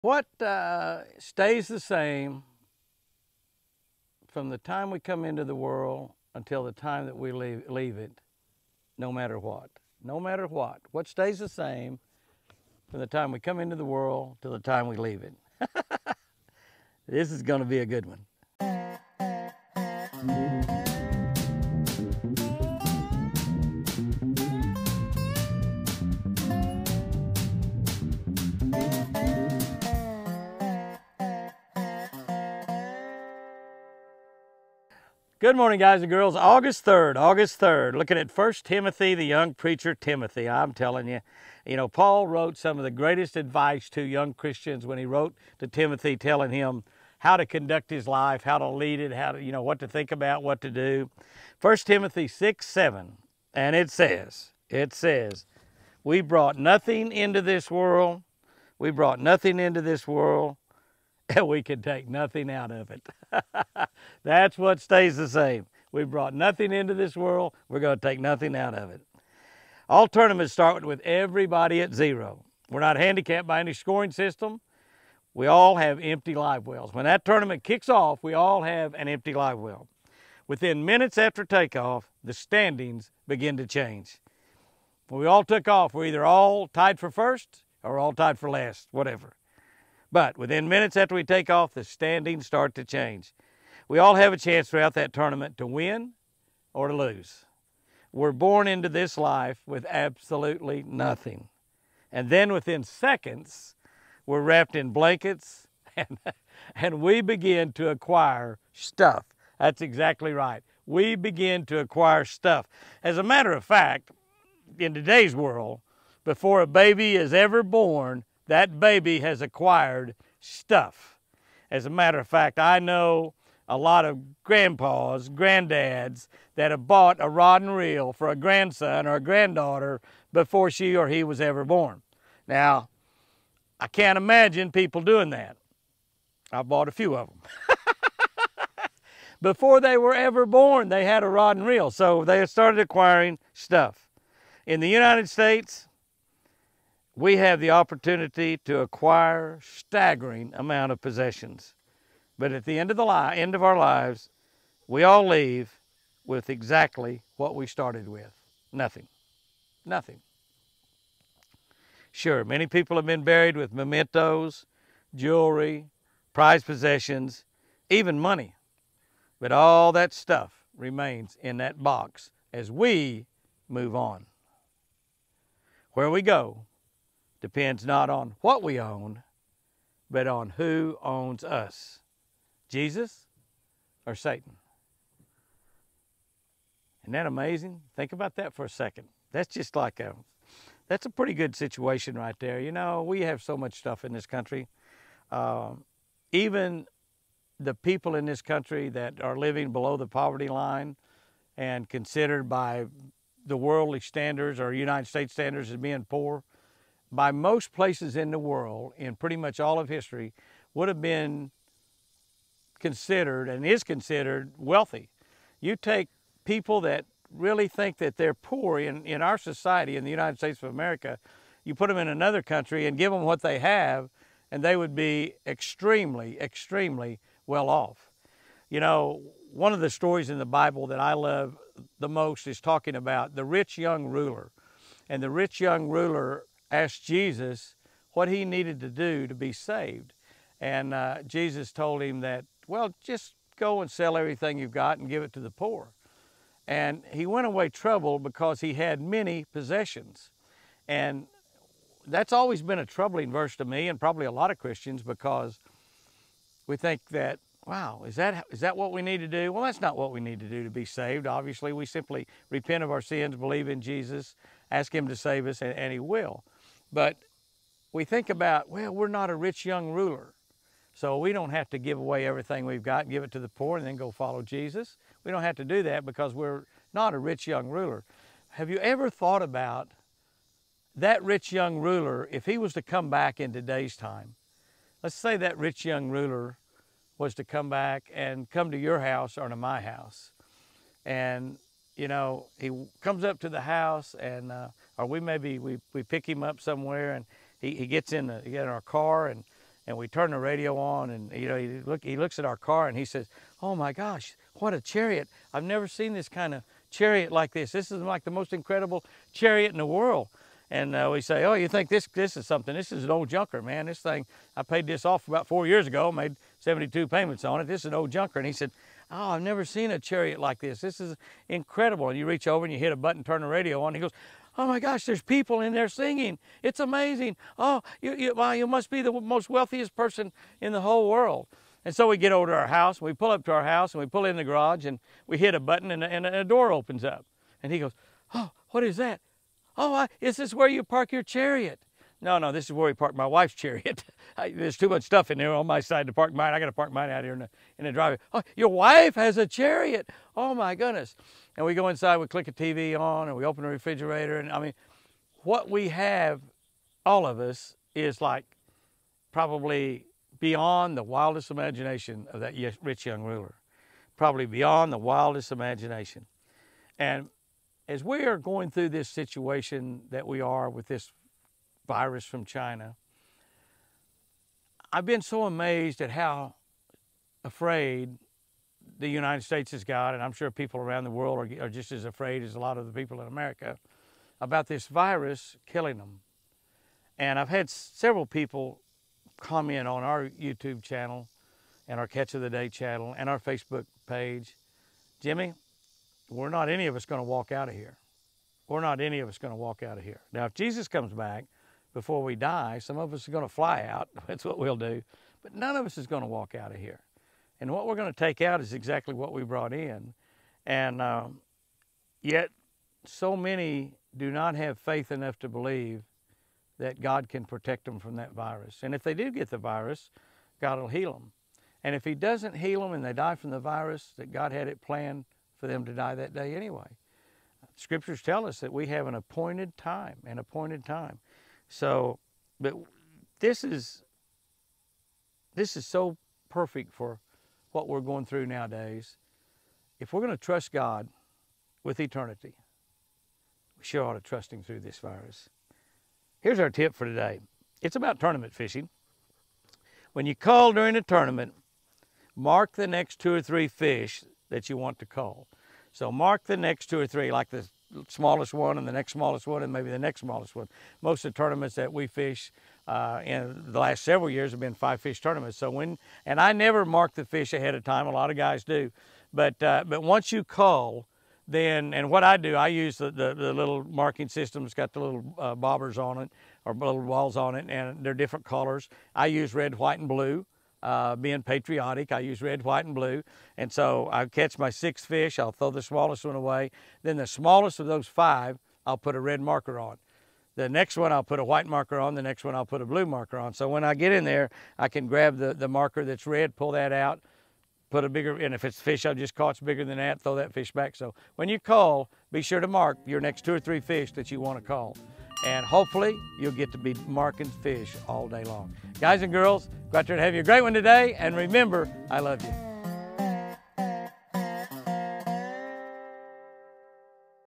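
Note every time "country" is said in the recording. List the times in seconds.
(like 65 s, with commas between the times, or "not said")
194 s, 198 s, 222 s.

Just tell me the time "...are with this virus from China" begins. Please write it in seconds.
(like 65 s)
370 s.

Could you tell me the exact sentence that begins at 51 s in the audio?
First Timothy 6, 7, and it says, it says, we brought nothing into this world.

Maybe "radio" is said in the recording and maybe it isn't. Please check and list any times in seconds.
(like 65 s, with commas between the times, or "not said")
300 s, 323 s.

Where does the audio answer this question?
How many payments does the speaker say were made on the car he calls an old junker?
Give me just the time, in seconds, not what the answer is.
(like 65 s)
316 s.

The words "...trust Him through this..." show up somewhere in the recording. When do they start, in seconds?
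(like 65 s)
444 s.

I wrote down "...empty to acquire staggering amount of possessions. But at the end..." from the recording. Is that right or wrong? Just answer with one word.
wrong.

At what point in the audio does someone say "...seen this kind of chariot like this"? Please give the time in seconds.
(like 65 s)
305 s.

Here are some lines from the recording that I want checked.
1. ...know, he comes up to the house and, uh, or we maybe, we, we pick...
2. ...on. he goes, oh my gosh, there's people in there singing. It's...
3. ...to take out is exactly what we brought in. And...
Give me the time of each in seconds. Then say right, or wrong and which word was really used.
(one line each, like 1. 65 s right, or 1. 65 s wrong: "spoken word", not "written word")
1. 292 s right
2. 323 s right
3. 408 s right.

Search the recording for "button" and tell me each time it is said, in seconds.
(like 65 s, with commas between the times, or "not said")
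322 s, 335 s.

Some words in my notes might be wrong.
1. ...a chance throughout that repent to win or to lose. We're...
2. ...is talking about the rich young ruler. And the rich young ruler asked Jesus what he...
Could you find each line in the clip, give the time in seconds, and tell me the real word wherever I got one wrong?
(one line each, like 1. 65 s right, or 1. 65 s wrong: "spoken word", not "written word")
1. 94 s wrong: "tournament", not "repent"
2. 232 s right.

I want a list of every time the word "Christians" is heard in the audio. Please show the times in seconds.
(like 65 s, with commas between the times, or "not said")
44 s, 254 s.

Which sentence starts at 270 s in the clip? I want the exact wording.
So we don't have to give away everything we've got, give it to the poor, and then go follow Jesus.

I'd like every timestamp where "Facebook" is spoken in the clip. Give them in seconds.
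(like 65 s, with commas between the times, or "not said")
393 s.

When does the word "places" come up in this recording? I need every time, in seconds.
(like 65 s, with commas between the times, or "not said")
207 s.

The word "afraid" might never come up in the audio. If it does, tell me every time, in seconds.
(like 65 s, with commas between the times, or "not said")
377 s, 382 s.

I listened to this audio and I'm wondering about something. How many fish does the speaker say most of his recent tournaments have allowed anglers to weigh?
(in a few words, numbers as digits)
5.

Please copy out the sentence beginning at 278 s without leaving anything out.
Have you ever thought about that rich young ruler, if he was to come back in today's time?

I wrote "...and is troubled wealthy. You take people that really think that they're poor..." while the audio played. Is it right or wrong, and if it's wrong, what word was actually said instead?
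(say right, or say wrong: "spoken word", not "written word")
wrong: "considered", not "troubled".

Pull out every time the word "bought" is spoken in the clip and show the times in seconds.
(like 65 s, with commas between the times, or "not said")
126 s, 136 s.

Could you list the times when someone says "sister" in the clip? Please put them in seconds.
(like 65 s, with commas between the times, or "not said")
not said.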